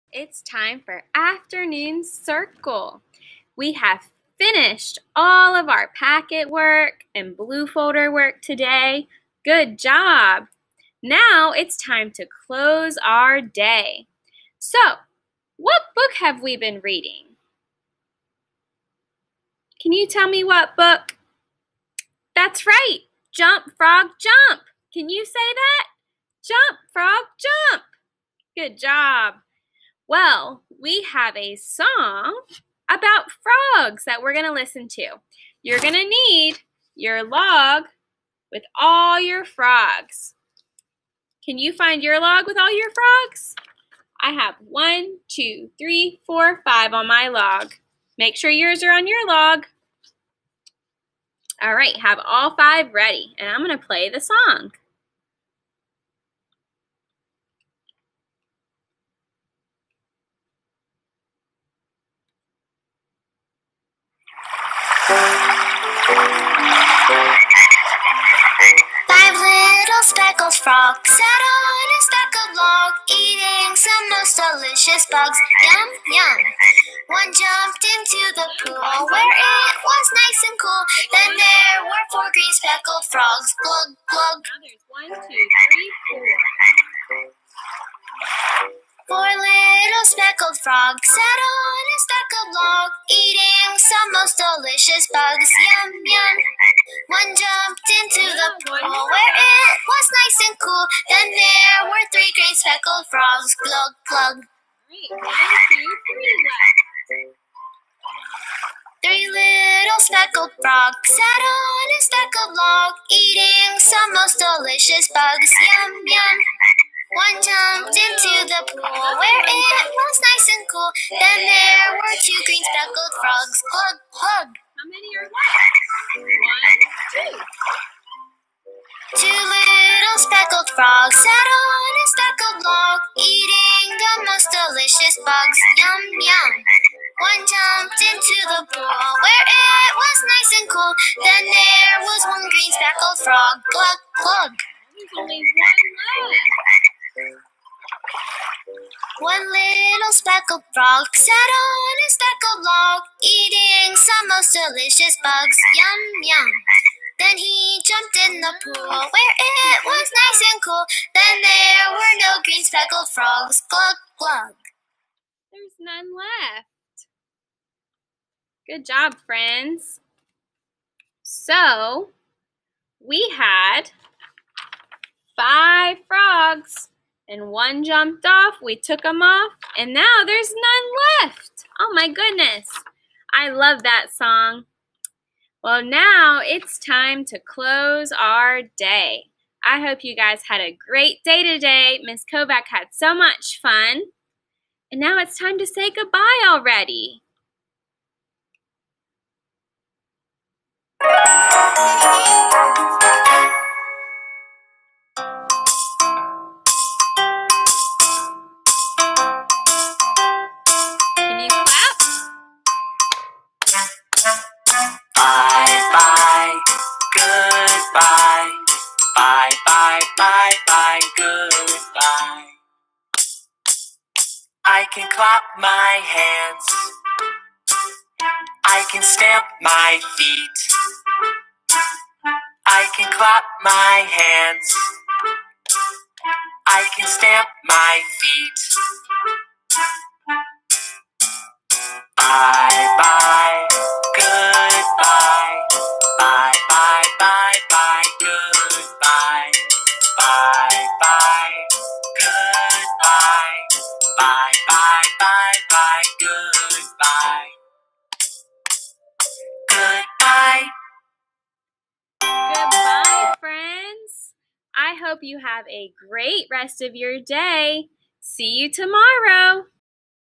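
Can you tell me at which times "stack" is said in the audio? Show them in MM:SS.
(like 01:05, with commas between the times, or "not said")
01:12, 01:31.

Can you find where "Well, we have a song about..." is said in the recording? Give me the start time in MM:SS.
00:30.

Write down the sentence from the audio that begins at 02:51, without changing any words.
So, we had five frogs and one jumped off.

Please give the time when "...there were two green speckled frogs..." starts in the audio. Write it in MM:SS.
02:01.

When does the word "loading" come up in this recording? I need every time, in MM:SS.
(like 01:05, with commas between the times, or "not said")
not said.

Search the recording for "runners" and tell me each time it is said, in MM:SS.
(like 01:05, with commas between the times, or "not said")
not said.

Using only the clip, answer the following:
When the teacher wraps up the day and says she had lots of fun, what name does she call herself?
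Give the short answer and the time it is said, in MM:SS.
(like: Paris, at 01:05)
Miss Kovach, at 03:12.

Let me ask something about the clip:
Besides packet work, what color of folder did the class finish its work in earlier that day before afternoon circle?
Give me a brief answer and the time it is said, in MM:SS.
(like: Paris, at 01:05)
Blue, at 00:07.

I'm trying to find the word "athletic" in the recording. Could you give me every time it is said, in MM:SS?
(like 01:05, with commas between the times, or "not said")
not said.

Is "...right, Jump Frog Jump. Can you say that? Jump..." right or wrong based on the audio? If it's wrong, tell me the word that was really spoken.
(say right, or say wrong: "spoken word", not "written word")
right.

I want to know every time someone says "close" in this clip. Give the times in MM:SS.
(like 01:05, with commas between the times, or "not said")
00:12, 03:07.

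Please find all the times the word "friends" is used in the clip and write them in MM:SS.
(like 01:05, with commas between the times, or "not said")
02:49, 04:23.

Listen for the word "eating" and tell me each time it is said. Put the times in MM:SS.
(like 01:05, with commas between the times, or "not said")
01:13, 01:33, 01:53, 02:13, 02:33.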